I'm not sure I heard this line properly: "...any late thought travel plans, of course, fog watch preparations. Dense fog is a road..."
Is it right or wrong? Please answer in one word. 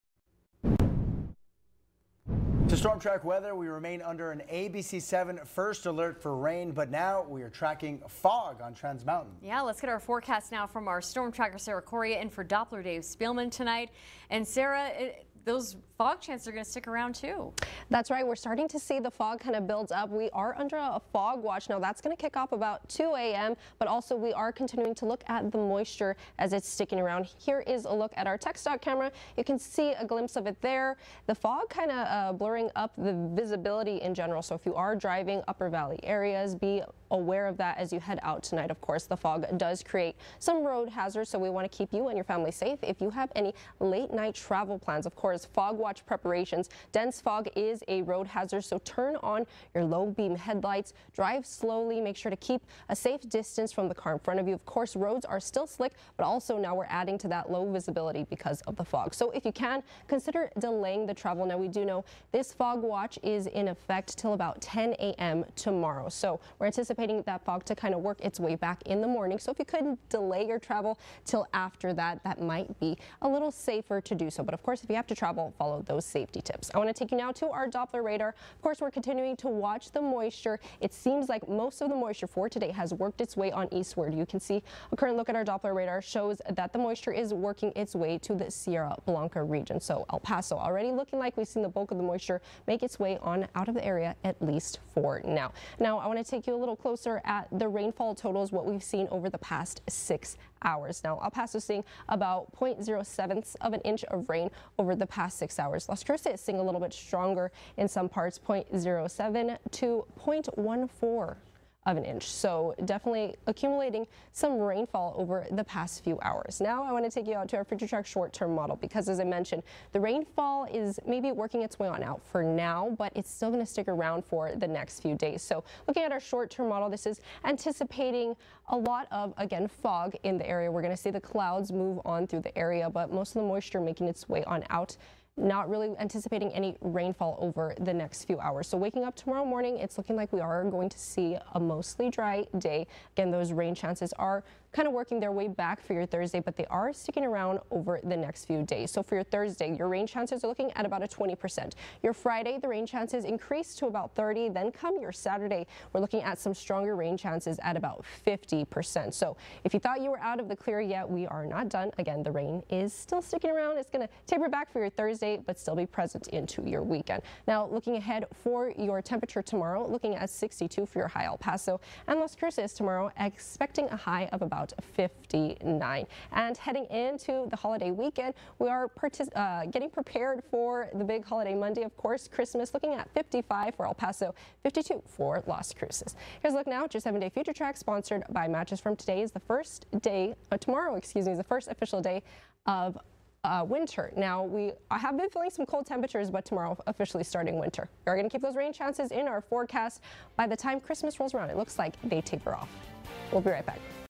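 wrong.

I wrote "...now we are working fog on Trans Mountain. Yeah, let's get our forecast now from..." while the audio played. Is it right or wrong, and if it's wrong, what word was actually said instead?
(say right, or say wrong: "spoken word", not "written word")
wrong: "tracking", not "working".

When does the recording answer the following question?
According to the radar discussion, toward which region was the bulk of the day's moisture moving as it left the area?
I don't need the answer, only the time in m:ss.
1:28.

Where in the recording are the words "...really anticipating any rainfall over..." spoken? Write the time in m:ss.
2:15.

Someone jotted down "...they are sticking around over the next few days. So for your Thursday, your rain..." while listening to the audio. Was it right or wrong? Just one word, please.
right.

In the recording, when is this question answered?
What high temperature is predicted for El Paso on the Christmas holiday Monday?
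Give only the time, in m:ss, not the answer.
3:03.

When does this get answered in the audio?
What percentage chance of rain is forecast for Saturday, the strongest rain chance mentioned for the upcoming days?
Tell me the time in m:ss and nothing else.
2:38.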